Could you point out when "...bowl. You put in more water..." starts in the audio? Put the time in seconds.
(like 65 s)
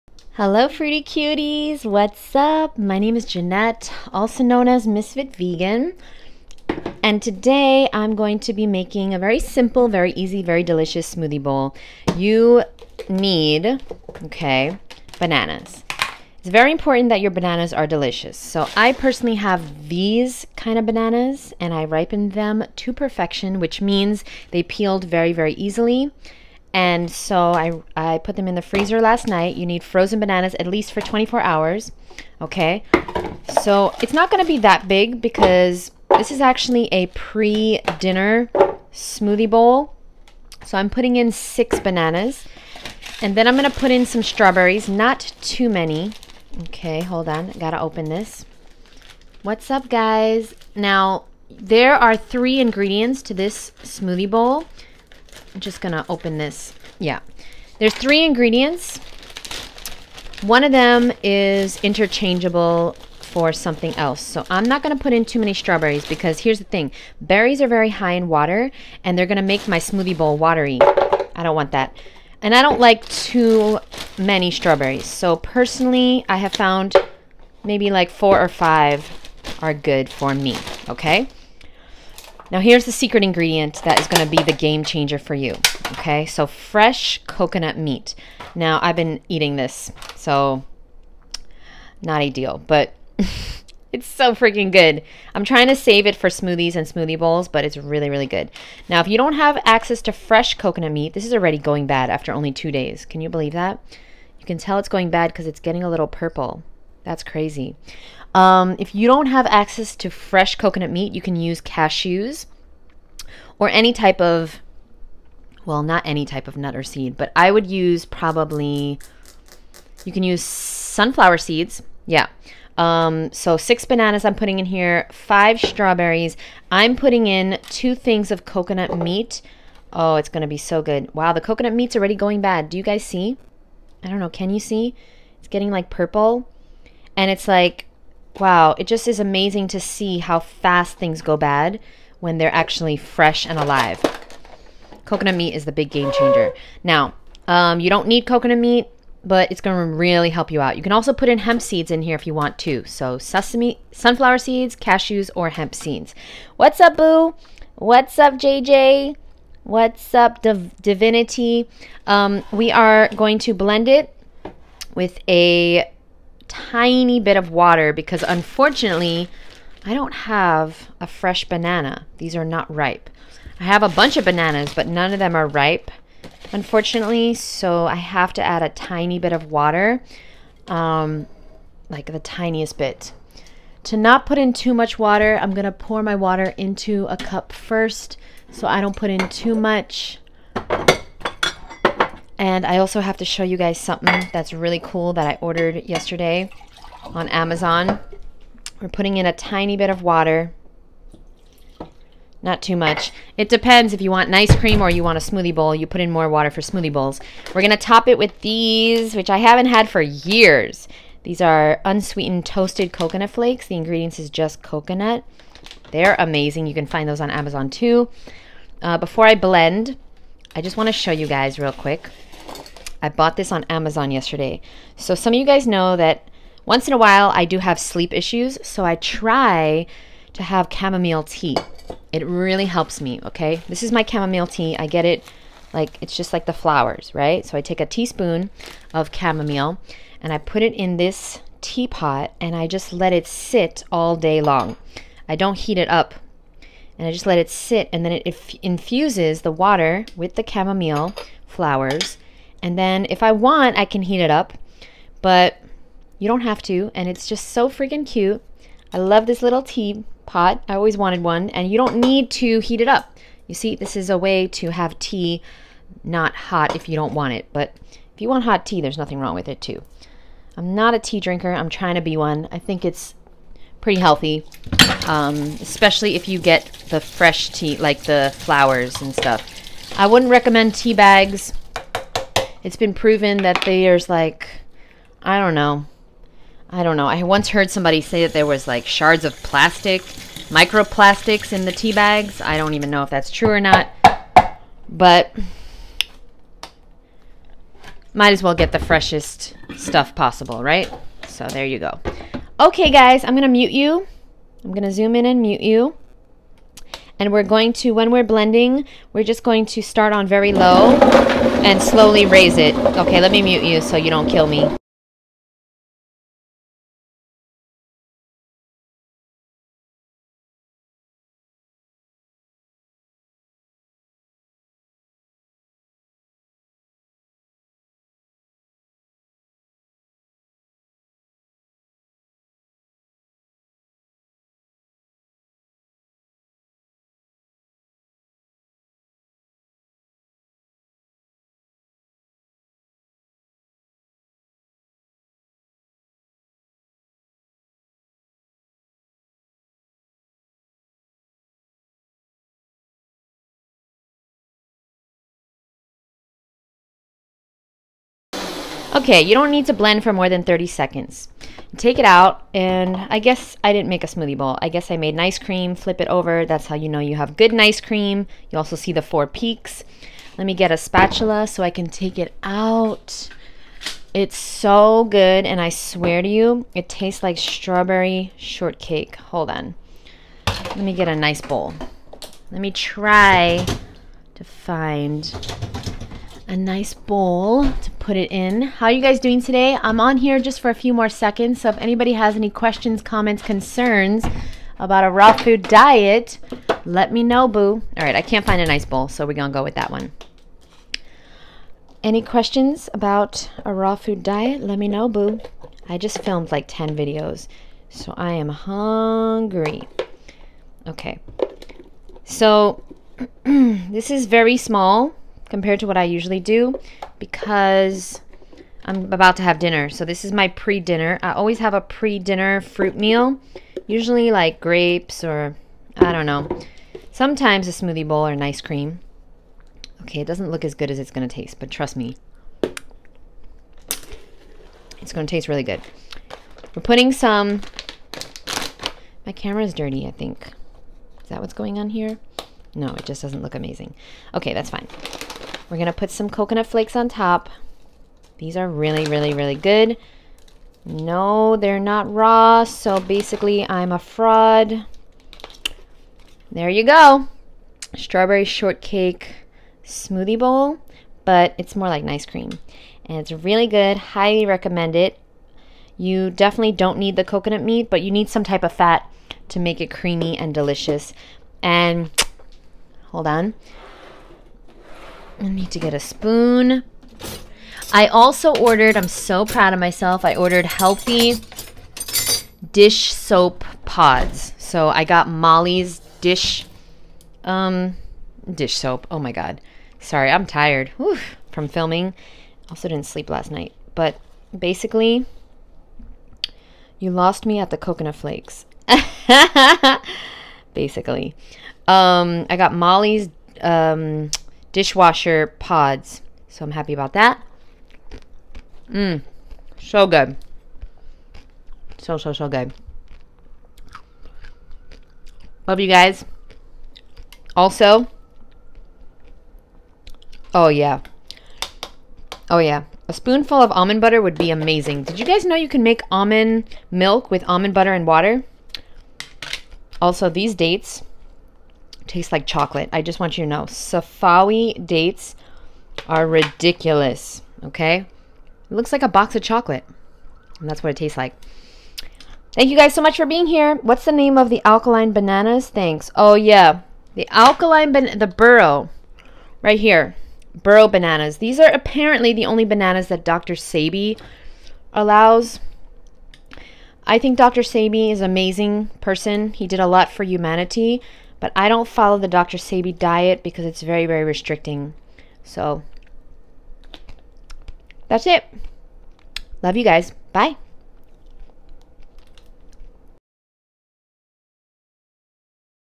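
205 s.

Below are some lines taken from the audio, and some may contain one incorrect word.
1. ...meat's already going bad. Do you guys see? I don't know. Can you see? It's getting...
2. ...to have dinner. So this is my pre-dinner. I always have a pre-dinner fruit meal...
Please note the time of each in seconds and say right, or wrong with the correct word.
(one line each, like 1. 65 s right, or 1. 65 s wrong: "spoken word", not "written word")
1. 131 s right
2. 419 s right.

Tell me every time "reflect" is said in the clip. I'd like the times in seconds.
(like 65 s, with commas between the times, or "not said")
not said.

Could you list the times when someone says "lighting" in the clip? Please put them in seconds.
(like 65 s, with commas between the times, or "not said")
not said.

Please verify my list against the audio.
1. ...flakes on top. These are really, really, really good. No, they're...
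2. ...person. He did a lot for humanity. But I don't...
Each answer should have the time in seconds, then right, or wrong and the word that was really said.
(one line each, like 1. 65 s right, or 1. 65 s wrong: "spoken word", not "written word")
1. 446 s right
2. 558 s right.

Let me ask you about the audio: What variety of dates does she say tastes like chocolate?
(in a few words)
Safawi.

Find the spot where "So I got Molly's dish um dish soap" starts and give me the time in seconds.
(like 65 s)
484 s.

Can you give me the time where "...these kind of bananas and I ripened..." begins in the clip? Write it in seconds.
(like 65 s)
19 s.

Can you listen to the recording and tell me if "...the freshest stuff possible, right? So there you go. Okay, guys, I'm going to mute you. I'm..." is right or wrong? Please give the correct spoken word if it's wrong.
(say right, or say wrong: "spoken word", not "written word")
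right.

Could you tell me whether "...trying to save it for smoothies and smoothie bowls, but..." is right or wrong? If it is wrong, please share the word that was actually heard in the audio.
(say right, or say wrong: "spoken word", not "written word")
right.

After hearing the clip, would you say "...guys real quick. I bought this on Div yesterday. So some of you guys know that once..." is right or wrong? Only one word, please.
wrong.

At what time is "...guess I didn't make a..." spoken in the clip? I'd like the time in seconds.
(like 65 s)
363 s.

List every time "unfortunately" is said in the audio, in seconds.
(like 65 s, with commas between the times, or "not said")
168 s, 176 s.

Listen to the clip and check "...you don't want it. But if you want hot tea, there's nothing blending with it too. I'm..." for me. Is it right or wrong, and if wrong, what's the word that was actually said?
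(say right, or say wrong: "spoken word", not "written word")
wrong: "wrong", not "blending".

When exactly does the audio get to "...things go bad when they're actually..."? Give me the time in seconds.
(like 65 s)
140 s.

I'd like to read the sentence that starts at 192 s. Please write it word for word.
And I also have to show you guys something that's really cool that I ordered yesterday on Amazon.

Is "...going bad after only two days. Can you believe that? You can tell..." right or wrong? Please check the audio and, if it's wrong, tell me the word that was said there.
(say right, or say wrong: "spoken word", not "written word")
right.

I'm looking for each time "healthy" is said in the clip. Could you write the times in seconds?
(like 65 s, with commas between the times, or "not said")
273 s, 480 s.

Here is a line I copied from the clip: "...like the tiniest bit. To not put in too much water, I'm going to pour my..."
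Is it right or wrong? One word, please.
right.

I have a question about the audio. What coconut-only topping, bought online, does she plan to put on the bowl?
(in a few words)
Unsweetened toasted coconut flakes.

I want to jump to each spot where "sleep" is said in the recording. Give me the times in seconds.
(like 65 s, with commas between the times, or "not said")
227 s, 493 s.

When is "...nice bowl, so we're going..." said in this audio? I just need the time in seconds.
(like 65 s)
398 s.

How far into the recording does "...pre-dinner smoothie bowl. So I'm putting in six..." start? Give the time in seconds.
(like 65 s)
37 s.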